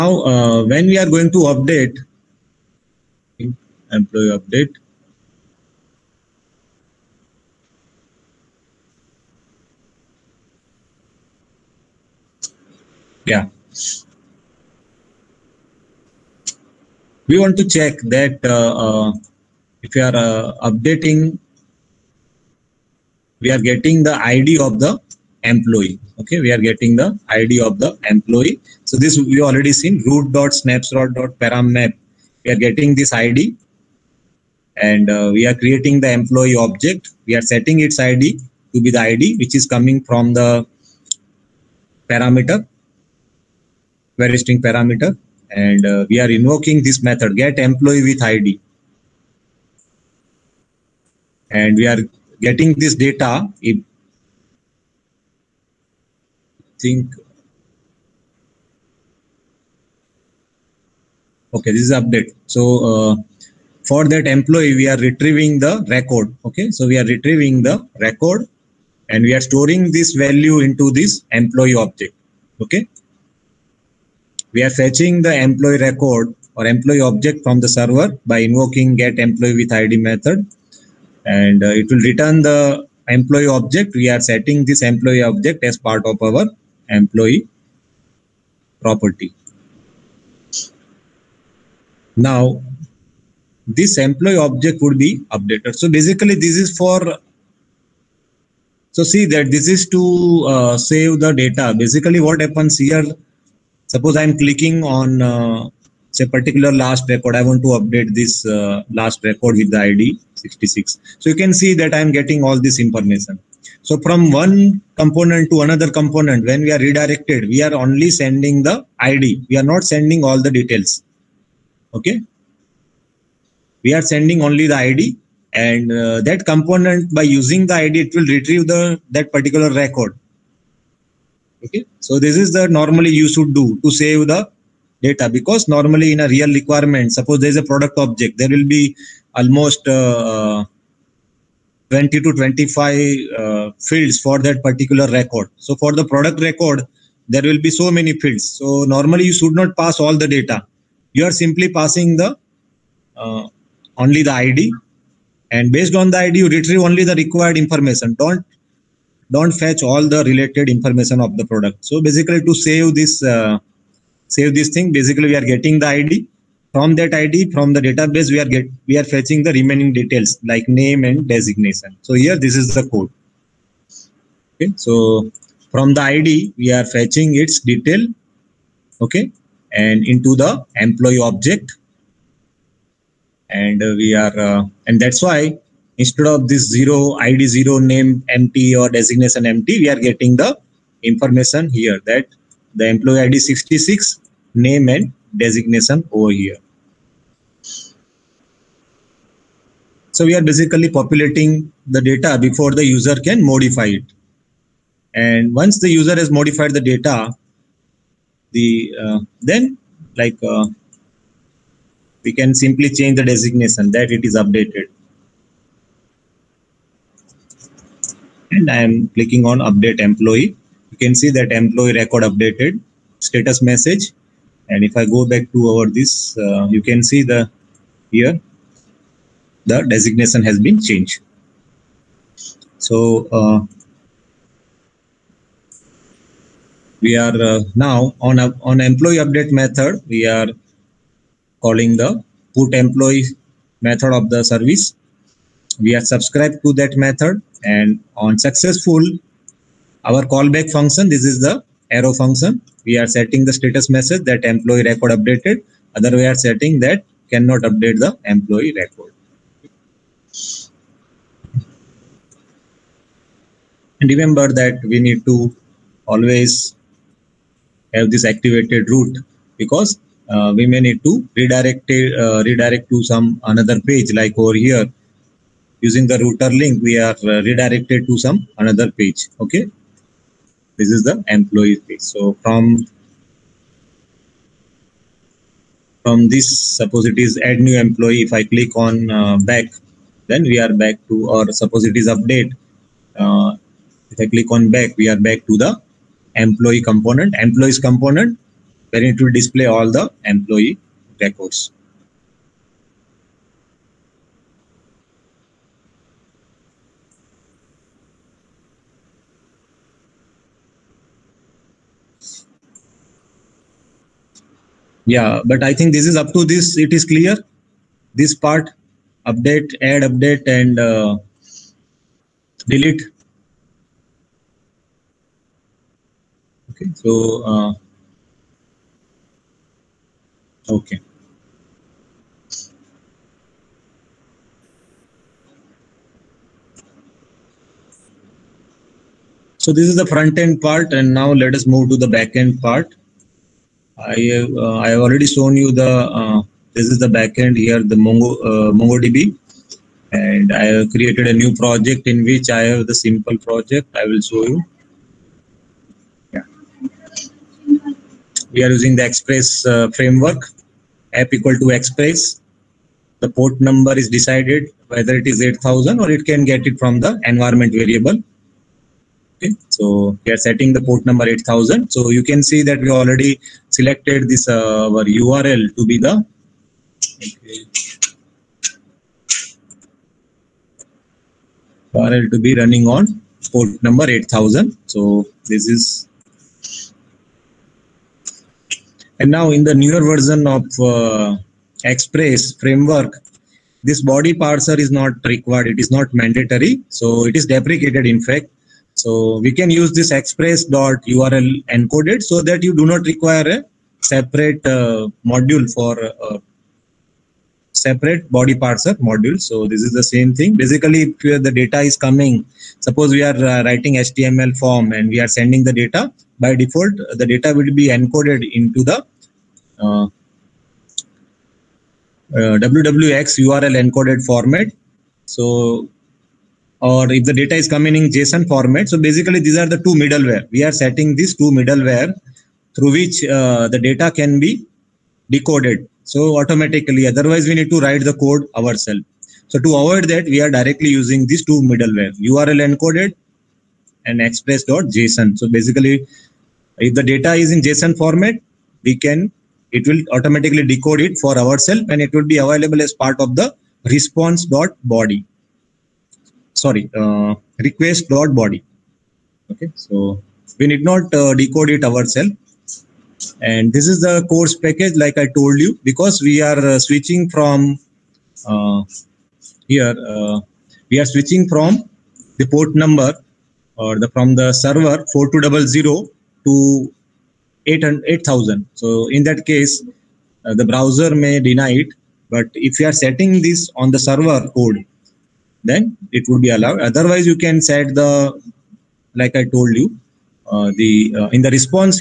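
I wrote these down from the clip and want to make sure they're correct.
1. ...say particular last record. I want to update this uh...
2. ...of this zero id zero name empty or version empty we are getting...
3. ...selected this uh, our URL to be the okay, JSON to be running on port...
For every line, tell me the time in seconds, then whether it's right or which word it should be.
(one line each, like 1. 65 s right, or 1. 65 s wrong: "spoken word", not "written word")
1. 106 s right
2. 186 s wrong: "designation", not "version"
3. 373 s wrong: "URL", not "JSON".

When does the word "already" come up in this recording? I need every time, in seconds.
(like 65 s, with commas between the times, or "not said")
29 s, 345 s, 372 s.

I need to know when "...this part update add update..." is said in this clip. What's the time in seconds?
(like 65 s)
318 s.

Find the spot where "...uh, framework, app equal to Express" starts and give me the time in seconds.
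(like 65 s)
359 s.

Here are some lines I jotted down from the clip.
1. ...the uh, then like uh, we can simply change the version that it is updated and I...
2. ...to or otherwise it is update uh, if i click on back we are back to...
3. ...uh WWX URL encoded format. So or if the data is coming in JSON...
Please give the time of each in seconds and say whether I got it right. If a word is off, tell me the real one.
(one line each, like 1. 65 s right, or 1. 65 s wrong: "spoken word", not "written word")
1. 208 s wrong: "designation", not "version"
2. 291 s wrong: "suppose", not "otherwise"
3. 422 s right.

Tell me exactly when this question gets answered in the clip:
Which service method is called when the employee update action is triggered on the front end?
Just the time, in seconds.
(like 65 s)
242 s.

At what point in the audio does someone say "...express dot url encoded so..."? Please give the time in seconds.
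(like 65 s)
400 s.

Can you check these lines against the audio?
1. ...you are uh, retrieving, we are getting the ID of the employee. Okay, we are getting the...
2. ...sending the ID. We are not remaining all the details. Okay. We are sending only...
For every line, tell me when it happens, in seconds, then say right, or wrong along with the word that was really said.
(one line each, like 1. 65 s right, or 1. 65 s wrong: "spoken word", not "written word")
1. 19 s wrong: "updating", not "retrieving"
2. 118 s wrong: "sending", not "remaining".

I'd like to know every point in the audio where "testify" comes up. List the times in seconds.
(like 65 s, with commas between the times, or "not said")
not said.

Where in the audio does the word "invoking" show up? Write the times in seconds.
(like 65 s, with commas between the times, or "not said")
46 s, 78 s.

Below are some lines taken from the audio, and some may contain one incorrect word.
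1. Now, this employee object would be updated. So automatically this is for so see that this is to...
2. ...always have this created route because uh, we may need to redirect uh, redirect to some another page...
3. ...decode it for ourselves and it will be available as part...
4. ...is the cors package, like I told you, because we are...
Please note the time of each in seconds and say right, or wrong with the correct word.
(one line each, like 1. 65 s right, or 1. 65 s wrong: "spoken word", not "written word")
1. 92 s wrong: "basically", not "automatically"
2. 266 s wrong: "activated", not "created"
3. 450 s right
4. 463 s right.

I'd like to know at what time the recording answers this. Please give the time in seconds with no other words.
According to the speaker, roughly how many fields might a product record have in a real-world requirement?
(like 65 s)
141 s.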